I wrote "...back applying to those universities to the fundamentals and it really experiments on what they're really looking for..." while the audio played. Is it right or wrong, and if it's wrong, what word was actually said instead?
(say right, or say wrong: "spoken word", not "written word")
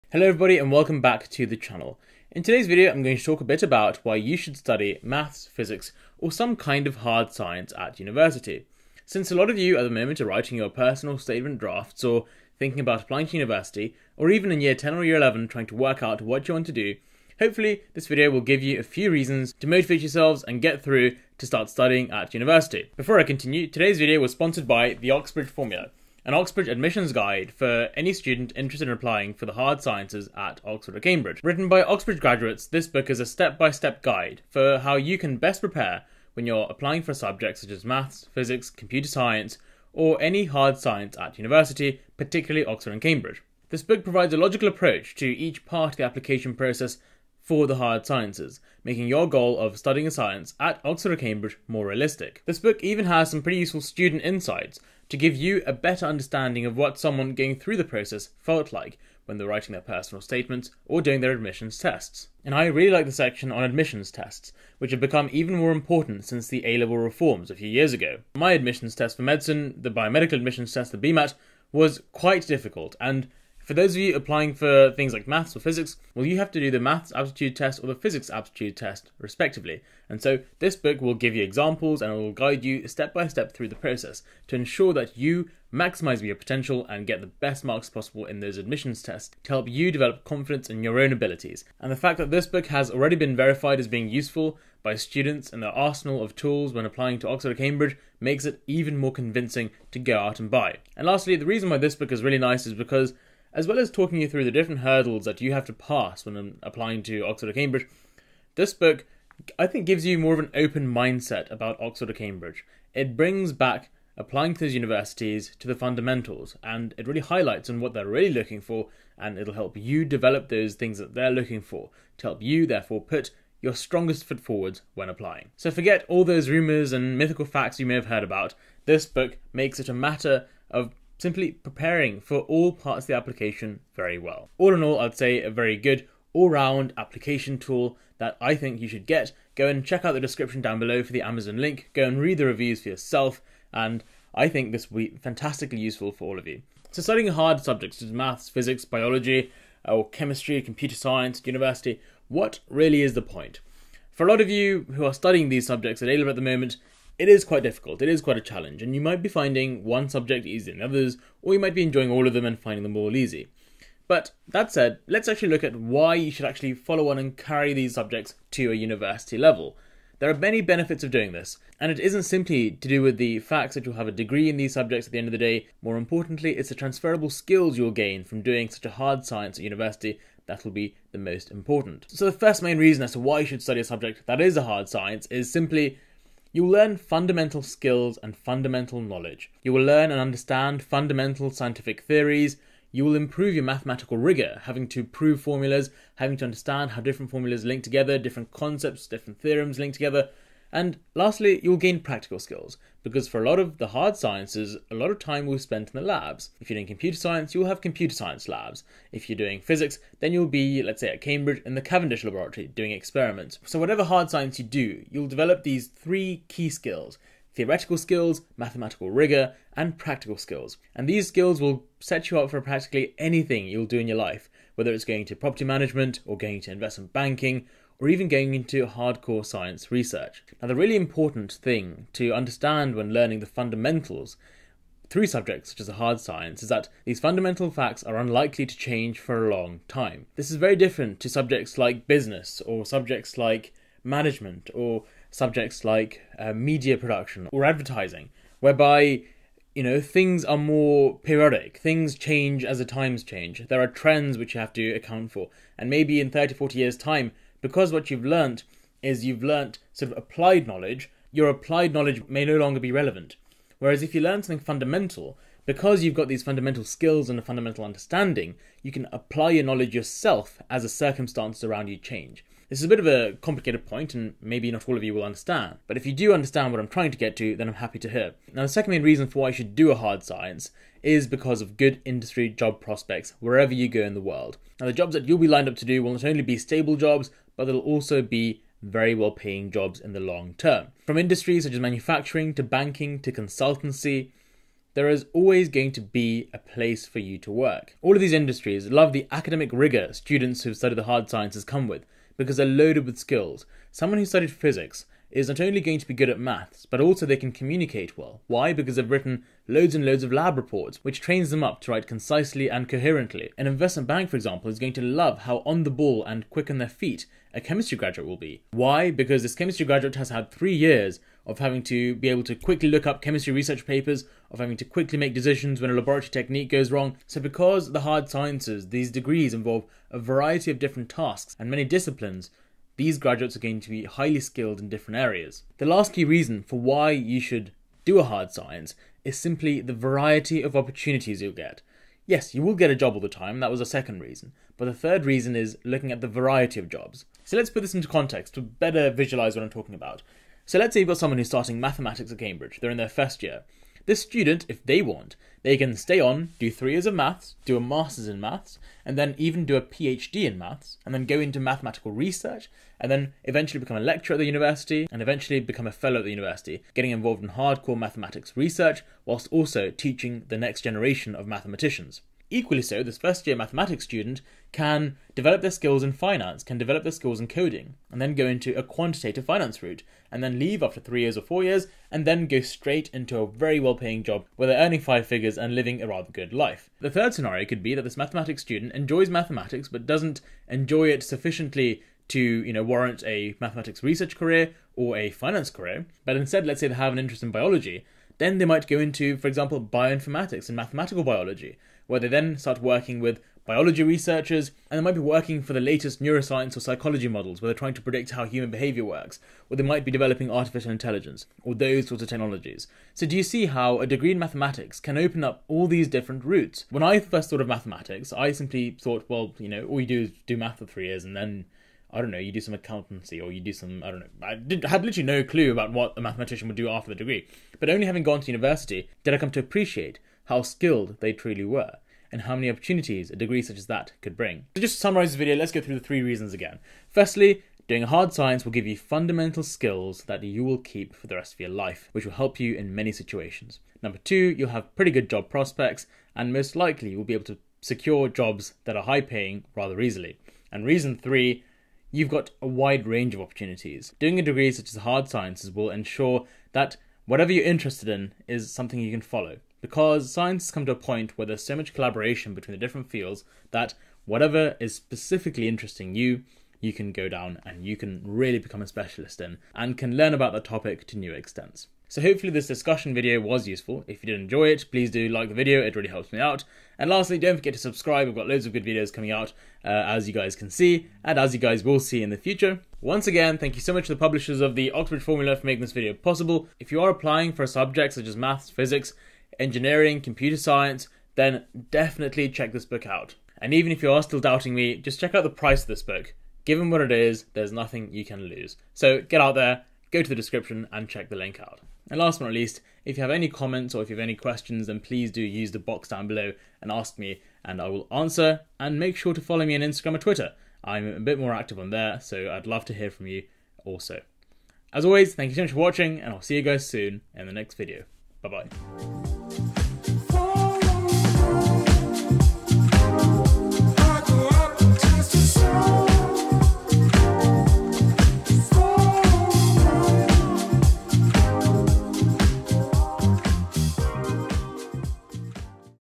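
wrong: "highlights", not "experiments".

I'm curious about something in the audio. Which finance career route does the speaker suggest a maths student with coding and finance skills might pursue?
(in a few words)
quantitative finance.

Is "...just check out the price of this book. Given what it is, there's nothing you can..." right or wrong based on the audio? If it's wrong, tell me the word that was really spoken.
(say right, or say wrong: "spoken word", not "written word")
right.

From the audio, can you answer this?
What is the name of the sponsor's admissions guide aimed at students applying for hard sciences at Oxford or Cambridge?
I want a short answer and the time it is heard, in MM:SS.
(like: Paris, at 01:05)
Oxbridge Formula, at 00:25.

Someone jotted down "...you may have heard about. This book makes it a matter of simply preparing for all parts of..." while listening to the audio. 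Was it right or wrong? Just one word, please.
right.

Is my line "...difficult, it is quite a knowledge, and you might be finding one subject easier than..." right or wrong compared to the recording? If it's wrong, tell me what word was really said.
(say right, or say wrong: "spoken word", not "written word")
wrong: "challenge", not "knowledge".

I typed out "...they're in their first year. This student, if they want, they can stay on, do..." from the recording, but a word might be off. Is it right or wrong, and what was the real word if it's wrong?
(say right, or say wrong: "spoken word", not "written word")
right.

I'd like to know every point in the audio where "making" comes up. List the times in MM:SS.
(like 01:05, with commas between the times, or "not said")
00:48, 08:05.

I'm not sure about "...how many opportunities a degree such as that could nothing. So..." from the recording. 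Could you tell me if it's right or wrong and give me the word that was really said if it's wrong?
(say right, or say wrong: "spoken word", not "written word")
wrong: "bring", not "nothing".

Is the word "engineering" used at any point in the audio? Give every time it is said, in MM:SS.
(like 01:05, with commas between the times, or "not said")
08:09.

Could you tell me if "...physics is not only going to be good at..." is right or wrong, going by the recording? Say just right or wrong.
right.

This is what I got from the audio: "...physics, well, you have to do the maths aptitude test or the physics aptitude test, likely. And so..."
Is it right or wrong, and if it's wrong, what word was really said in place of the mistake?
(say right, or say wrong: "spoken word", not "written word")
wrong: "respectively", not "likely".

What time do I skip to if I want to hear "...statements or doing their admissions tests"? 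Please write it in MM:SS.
01:00.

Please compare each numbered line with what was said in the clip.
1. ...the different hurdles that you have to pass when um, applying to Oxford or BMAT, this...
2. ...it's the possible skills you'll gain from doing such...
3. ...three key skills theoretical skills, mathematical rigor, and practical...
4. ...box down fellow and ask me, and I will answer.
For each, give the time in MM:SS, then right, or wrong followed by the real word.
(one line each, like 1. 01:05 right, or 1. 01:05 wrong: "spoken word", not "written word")
1. 01:44 wrong: "Cambridge", not "BMAT"
2. 02:56 wrong: "transferable", not "possible"
3. 03:35 right
4. 08:25 wrong: "below", not "fellow".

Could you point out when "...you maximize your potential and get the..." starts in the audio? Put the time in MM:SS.
01:25.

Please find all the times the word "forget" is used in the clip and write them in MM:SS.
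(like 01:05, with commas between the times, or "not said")
02:05, 07:57.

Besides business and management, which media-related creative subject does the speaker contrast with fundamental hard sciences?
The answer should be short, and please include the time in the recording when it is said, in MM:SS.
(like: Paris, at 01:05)
media production, at 04:06.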